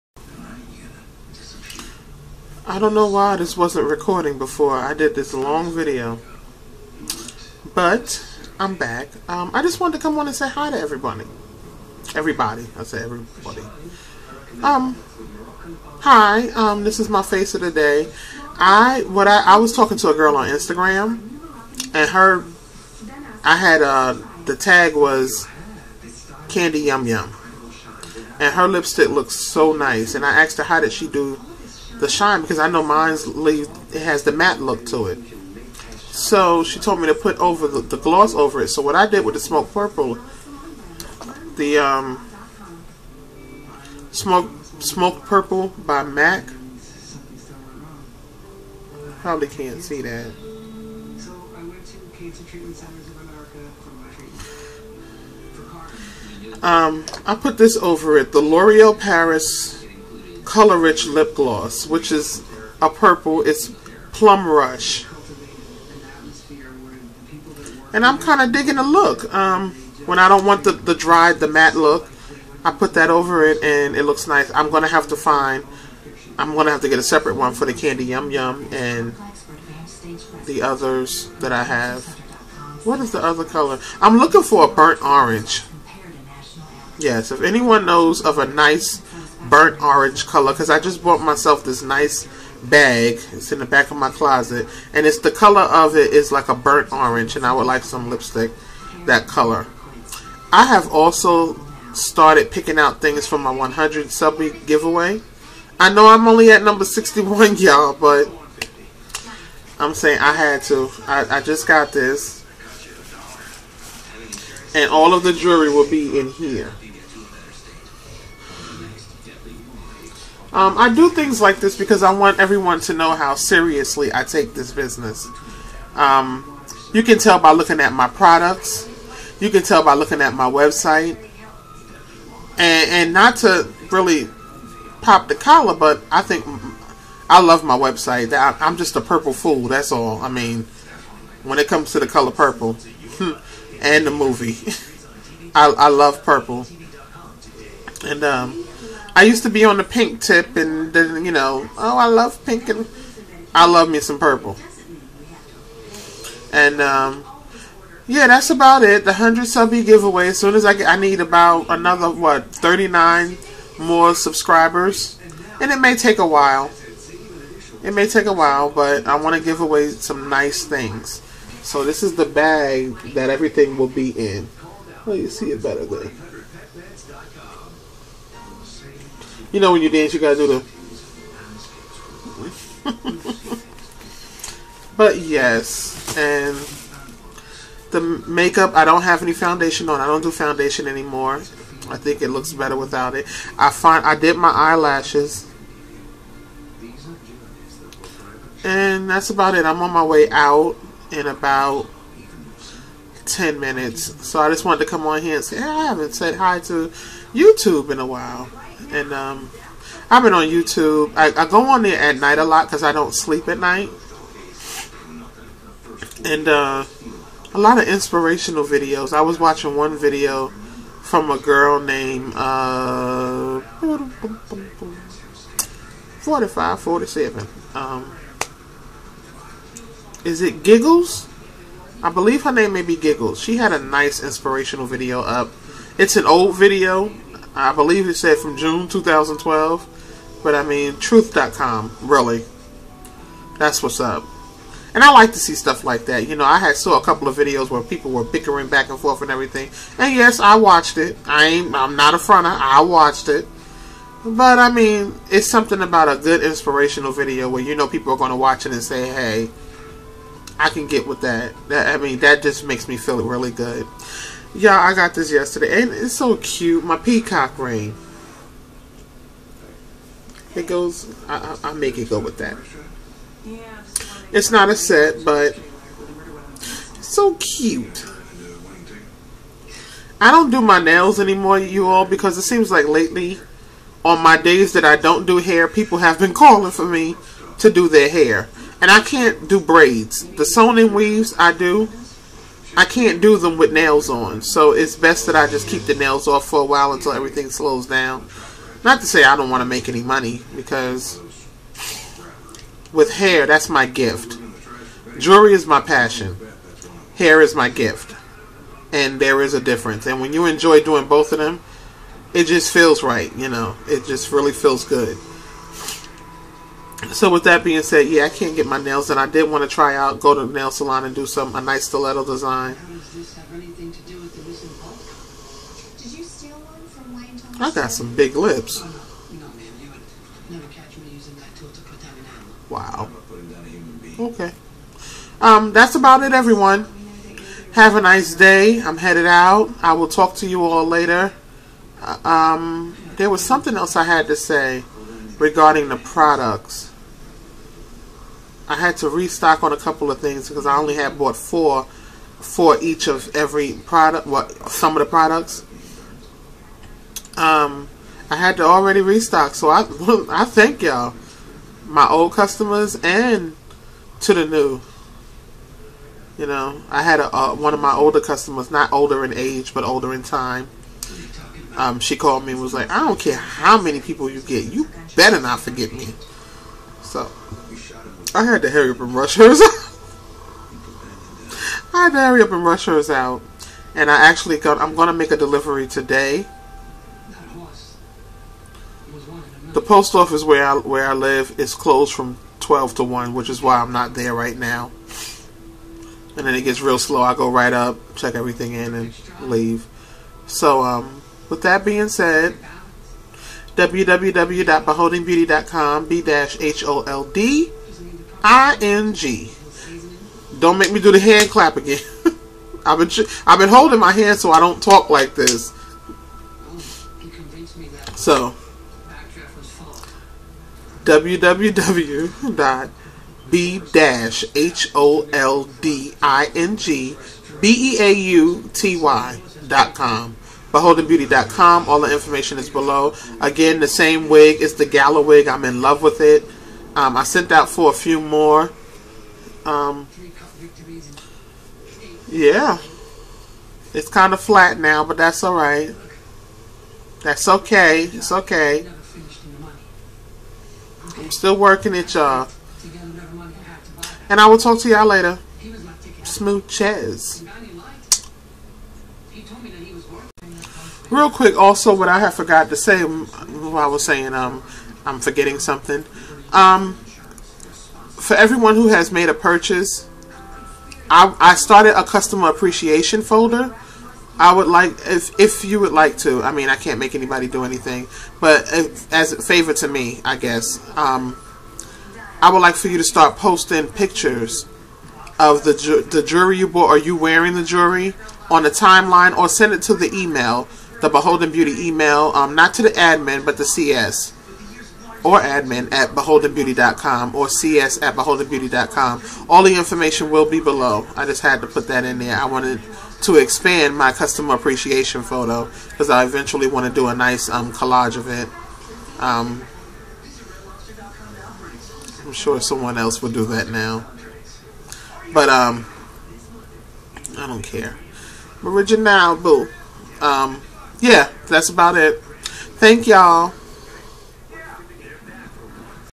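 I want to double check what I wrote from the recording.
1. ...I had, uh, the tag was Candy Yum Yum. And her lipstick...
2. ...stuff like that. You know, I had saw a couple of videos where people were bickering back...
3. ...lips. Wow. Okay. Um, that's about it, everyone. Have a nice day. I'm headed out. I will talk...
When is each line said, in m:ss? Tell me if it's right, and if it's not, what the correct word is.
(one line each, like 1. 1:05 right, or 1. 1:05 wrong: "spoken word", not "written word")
1. 0:23 right
2. 4:05 right
3. 5:28 right.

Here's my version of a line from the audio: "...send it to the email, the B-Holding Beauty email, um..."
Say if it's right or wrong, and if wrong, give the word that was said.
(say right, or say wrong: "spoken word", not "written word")
right.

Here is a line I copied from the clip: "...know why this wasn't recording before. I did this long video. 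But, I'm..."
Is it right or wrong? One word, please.
right.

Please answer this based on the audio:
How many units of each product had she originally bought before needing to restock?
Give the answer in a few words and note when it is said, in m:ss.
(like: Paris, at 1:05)
4, at 5:51.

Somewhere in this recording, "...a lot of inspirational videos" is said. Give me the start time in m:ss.
3:37.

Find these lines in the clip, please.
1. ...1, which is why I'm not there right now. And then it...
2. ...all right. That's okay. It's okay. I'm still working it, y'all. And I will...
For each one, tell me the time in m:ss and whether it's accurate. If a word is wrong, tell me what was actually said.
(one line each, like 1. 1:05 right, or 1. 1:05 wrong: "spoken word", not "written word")
1. 6:33 right
2. 7:25 right.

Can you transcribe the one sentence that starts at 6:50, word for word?
Don't make me do the hand clap again.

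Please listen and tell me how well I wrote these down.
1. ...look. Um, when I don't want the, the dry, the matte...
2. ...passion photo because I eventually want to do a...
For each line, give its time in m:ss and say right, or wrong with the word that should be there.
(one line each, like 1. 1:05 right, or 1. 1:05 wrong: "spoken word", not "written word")
1. 1:08 right
2. 8:24 wrong: "appreciation", not "passion".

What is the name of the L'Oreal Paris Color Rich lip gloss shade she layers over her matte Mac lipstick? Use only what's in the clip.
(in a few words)
Plum Rush.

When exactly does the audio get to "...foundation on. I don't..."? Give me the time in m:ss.
3:09.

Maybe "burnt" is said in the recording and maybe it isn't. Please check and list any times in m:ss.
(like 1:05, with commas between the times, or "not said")
1:24, 1:29, 1:36.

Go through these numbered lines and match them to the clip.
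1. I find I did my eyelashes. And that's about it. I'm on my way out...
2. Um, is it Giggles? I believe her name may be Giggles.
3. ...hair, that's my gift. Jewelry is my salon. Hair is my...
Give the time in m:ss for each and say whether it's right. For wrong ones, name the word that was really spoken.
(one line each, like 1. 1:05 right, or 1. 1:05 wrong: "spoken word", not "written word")
1. 3:13 right
2. 3:47 right
3. 5:03 wrong: "passion", not "salon".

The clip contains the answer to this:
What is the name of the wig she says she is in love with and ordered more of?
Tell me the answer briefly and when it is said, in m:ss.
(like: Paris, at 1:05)
Gala wig, at 7:14.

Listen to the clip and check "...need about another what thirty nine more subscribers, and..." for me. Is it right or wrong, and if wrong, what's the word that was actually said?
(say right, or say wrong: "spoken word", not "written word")
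right.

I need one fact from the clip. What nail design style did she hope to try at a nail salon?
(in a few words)
Stiletto.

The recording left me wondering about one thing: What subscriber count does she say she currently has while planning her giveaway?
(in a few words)
61.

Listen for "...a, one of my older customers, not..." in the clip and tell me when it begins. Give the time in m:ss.
6:07.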